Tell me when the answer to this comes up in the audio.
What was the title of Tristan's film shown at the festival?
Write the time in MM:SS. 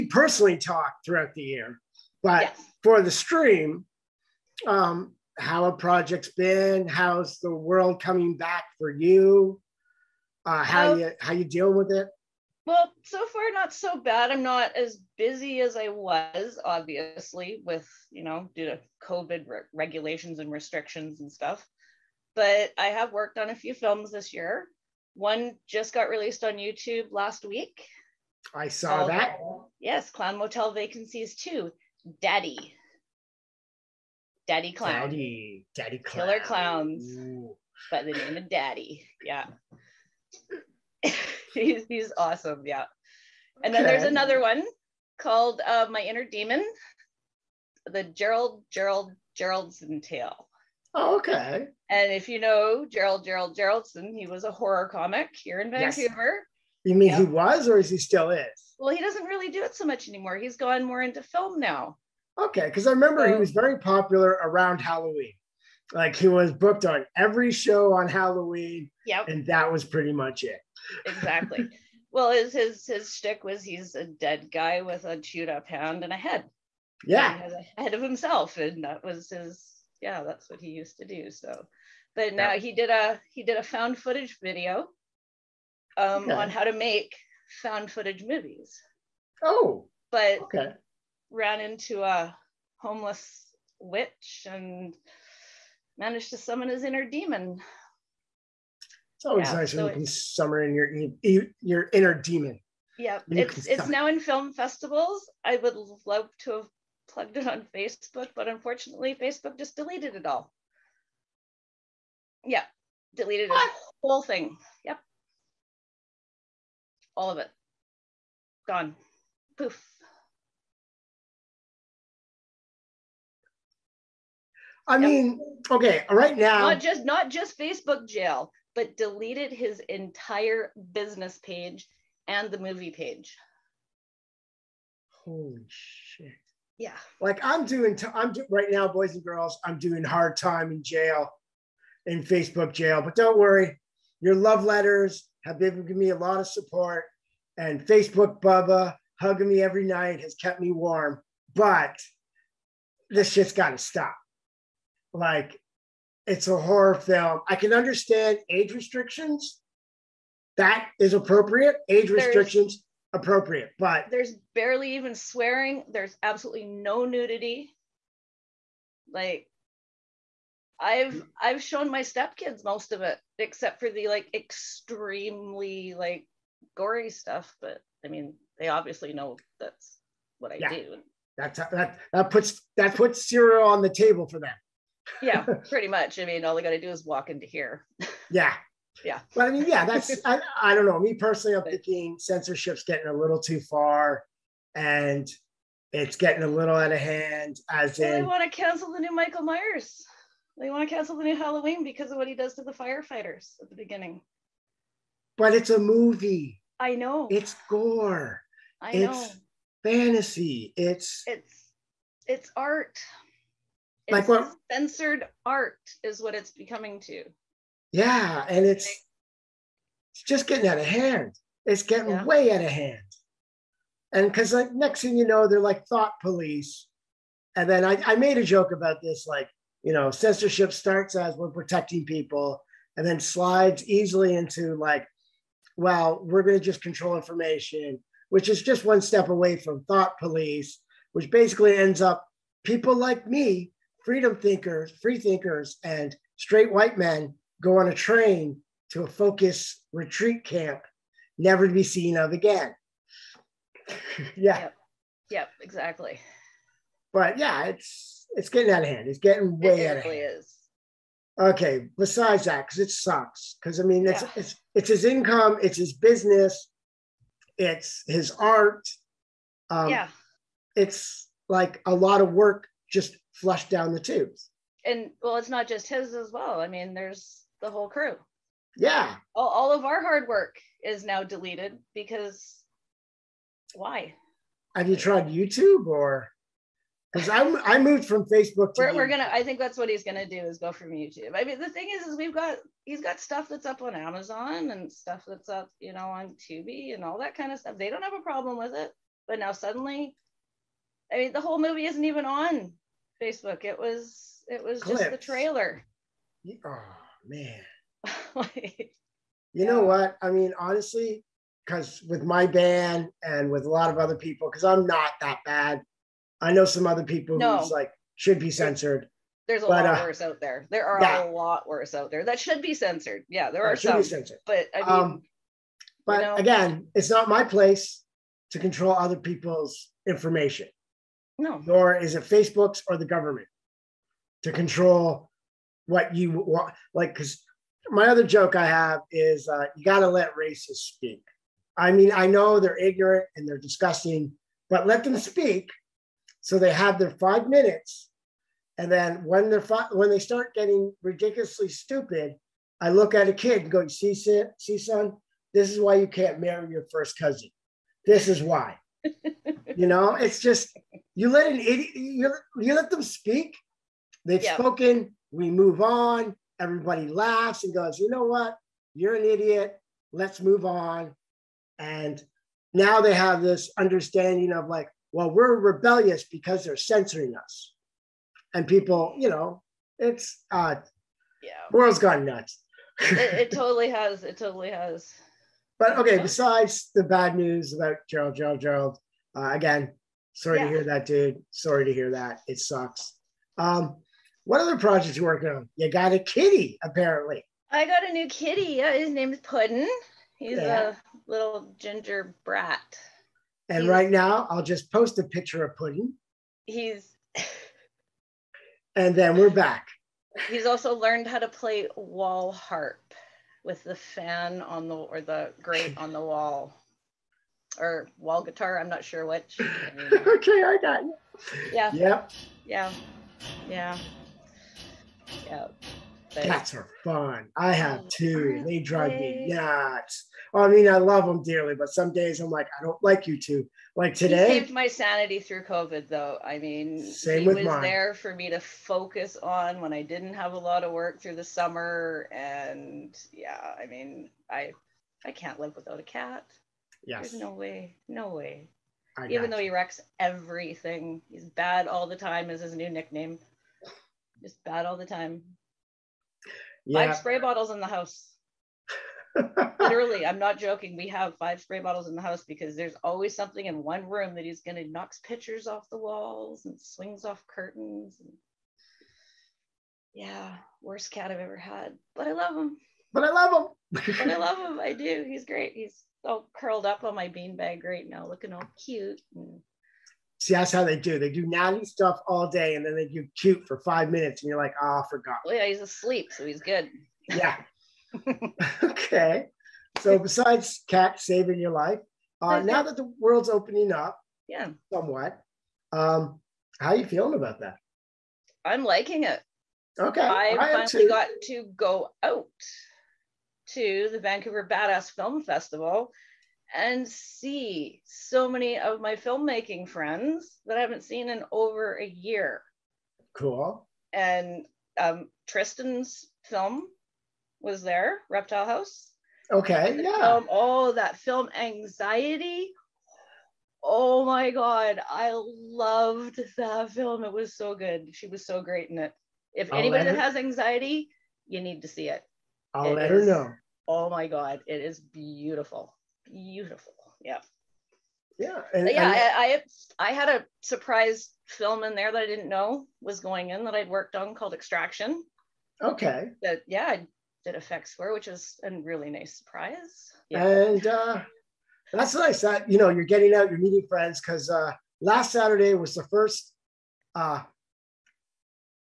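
08:38.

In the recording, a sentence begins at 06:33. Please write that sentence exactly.
Um, what other projects you working on?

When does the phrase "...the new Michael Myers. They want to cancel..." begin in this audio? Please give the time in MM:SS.
03:18.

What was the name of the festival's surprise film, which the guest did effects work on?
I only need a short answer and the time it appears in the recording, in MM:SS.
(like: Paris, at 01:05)
Extraction, at 09:04.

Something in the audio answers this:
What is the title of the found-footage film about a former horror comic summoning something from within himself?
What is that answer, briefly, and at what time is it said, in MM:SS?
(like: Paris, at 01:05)
My Inner Demon, at 00:45.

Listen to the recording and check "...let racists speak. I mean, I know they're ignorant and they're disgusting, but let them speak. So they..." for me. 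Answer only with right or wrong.
right.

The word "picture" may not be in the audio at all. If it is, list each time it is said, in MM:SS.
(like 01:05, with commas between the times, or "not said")
06:45, 07:45.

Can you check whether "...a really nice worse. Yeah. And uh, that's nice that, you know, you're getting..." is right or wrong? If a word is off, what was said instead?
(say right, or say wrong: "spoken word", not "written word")
wrong: "surprise", not "worse".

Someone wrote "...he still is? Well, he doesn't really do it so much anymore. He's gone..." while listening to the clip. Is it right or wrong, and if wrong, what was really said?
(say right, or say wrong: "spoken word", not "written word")
right.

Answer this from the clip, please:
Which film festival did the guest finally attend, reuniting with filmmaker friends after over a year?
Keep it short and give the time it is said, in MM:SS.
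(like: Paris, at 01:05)
Vancouver Badass Film Festival, at 08:24.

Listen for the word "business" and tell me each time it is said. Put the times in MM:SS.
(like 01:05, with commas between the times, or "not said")
02:10, 04:25.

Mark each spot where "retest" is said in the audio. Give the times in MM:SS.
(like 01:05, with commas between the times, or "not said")
not said.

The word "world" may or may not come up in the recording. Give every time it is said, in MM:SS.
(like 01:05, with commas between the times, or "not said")
00:07, 06:21, 08:13.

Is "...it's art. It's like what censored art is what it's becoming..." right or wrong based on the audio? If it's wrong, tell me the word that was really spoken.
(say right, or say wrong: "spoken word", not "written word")
right.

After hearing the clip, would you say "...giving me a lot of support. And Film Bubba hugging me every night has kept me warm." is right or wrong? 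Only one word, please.
wrong.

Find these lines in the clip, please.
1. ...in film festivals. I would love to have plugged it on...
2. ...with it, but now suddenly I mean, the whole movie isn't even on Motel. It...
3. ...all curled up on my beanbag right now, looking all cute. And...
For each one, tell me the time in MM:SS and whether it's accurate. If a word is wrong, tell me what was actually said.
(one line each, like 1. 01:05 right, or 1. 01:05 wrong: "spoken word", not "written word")
1. 01:44 right
2. 04:58 wrong: "Facebook", not "Motel"
3. 07:56 right.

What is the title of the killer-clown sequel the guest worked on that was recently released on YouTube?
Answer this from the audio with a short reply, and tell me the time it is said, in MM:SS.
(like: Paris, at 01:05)
Clown Motel Vacancies 2, at 00:30.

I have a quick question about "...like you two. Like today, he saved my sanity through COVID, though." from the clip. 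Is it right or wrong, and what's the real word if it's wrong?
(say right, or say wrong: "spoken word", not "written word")
right.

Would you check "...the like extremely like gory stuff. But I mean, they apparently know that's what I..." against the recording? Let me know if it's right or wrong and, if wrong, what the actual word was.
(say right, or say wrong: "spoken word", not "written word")
wrong: "obviously", not "apparently".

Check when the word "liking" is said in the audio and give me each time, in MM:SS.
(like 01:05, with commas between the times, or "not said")
08:18.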